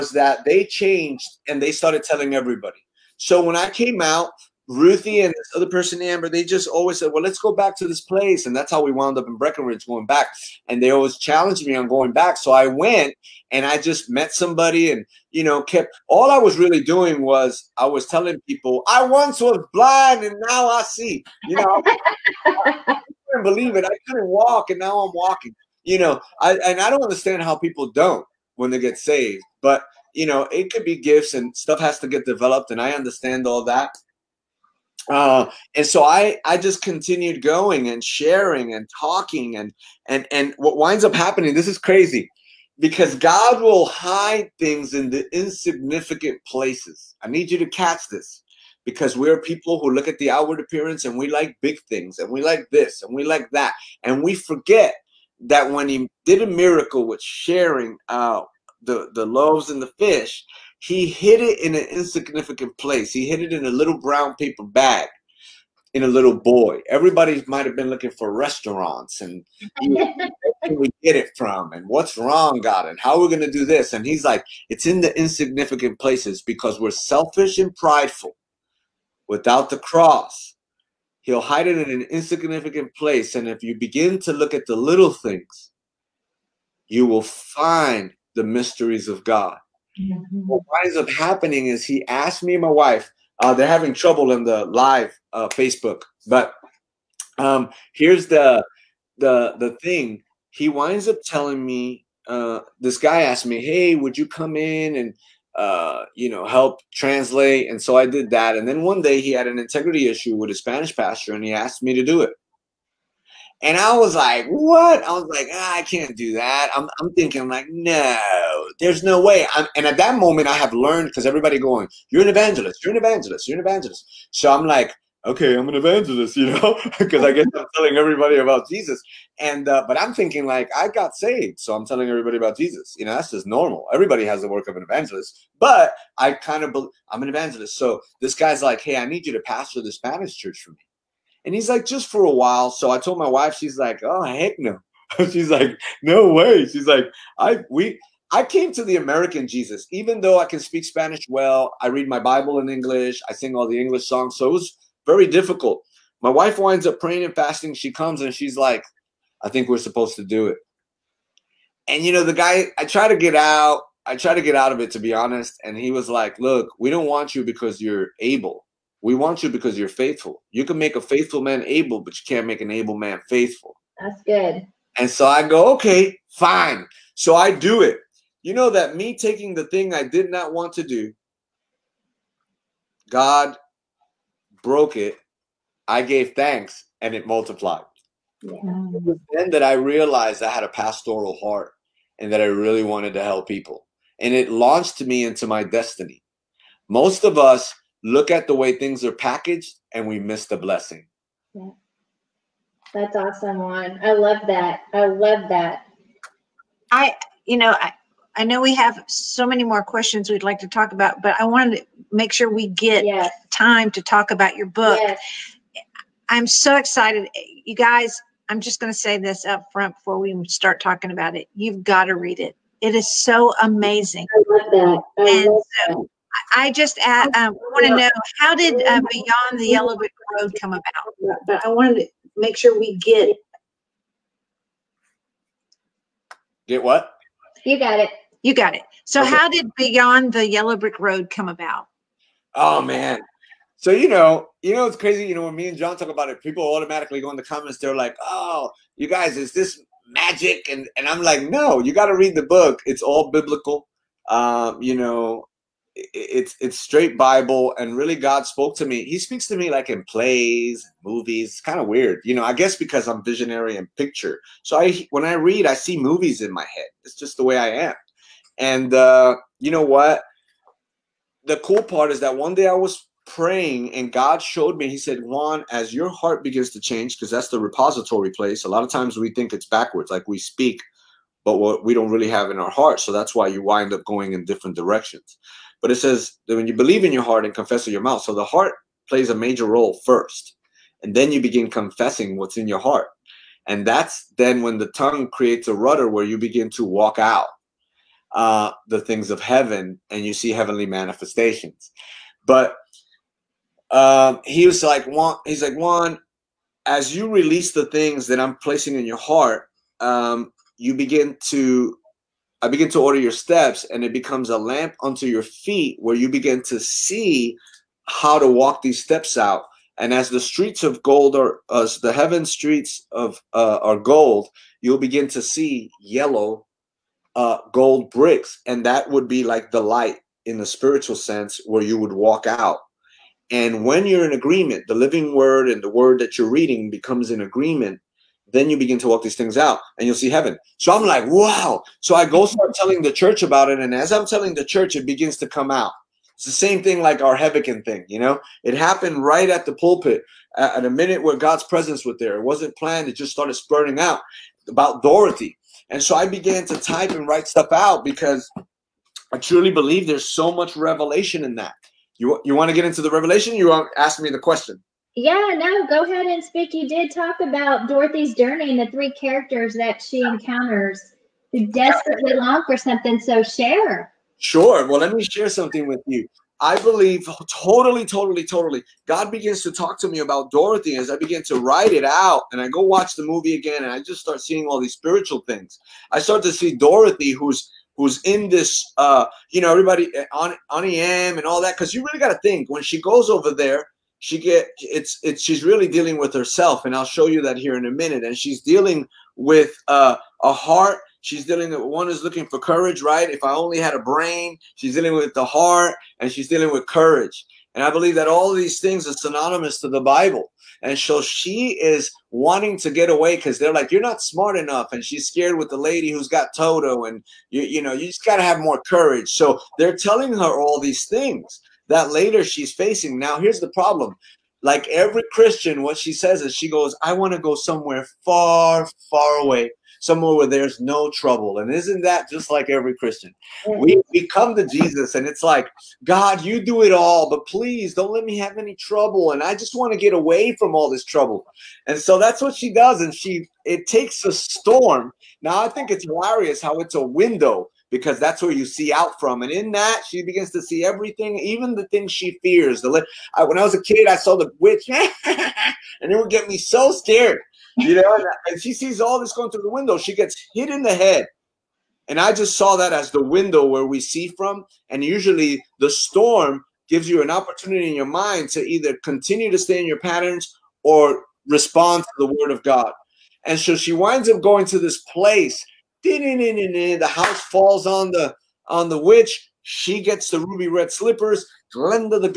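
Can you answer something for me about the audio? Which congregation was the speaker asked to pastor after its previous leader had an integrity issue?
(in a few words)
the Spanish church.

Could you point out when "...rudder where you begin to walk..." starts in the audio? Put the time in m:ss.
4:55.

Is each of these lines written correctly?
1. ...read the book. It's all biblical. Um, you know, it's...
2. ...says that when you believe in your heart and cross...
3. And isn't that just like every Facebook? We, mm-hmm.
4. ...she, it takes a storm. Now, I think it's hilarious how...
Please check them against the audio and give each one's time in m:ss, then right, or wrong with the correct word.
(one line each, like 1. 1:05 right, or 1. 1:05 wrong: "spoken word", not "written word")
1. 4:12 right
2. 4:45 wrong: "confess", not "cross"
3. 7:11 wrong: "Christian", not "Facebook"
4. 7:23 right.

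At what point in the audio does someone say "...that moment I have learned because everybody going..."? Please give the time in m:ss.
1:59.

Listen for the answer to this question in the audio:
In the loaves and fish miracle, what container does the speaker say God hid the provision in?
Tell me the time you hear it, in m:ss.
1:03.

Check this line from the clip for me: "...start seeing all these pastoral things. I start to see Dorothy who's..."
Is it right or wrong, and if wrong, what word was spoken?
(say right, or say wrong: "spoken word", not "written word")
wrong: "spiritual", not "pastoral".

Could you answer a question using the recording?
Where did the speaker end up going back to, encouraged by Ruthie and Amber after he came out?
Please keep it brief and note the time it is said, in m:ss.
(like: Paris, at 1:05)
Breckenridge, at 0:09.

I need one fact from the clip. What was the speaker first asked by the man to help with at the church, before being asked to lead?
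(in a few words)
translate.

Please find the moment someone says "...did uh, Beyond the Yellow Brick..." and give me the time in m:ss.
3:48.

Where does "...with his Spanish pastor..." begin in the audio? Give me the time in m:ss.
1:50.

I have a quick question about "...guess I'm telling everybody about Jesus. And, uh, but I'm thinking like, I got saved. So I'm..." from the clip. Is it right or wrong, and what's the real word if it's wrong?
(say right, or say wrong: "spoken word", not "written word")
right.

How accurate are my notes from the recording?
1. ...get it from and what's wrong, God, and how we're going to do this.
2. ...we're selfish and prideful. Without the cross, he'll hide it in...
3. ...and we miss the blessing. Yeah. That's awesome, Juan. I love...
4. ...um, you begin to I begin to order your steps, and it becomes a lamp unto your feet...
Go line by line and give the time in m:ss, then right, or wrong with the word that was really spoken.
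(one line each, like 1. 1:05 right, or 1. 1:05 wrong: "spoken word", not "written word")
1. 1:11 right
2. 1:16 right
3. 3:19 right
4. 5:09 right.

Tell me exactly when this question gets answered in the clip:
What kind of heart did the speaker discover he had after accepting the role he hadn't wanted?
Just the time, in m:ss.
3:10.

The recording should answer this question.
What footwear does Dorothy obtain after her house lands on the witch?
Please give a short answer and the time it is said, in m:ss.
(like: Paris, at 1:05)
ruby red slippers, at 8:00.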